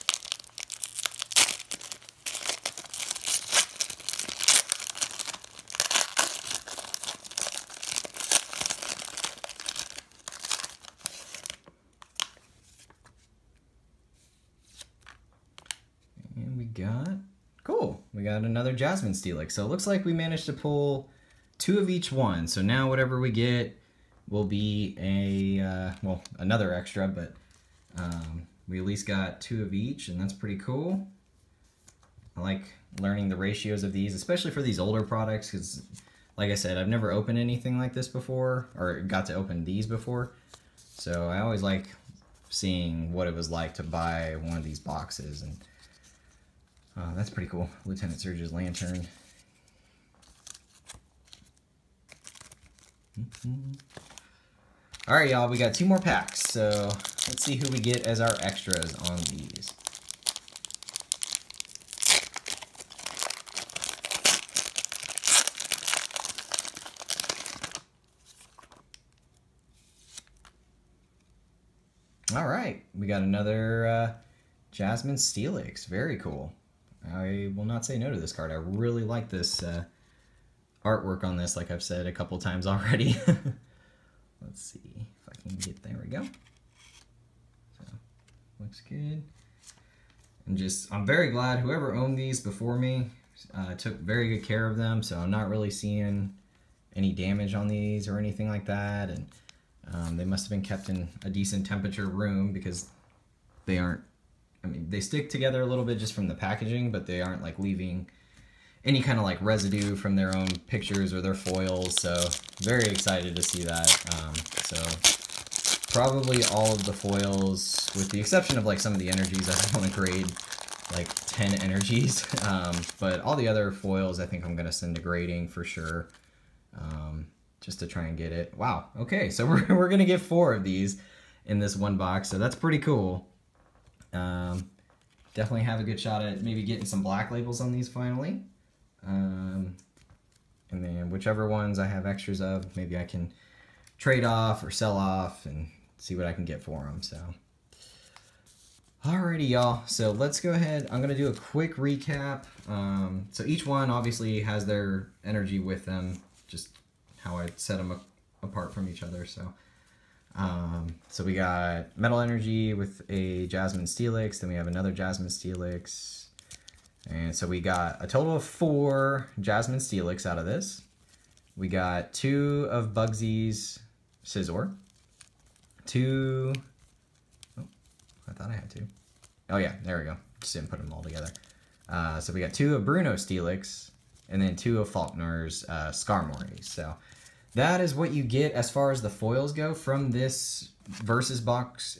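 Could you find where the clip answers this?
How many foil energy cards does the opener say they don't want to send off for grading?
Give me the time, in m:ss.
2:01.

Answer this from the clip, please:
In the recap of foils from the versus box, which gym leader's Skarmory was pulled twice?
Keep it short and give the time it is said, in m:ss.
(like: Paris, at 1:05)
Falkner, at 3:04.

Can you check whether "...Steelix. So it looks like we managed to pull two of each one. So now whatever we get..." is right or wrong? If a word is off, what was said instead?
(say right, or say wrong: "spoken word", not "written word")
right.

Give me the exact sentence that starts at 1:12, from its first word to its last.
All right, we got another uh, Jasmine Steelix.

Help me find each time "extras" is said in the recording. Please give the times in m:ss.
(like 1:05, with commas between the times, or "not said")
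0:26, 0:58, 2:22.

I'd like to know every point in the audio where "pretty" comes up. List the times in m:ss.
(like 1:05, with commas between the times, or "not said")
0:30, 0:47, 2:12.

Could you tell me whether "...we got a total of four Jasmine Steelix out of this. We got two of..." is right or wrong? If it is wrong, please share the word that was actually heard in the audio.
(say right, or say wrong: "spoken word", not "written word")
right.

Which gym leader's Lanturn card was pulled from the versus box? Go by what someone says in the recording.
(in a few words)
Lieutenant Surge.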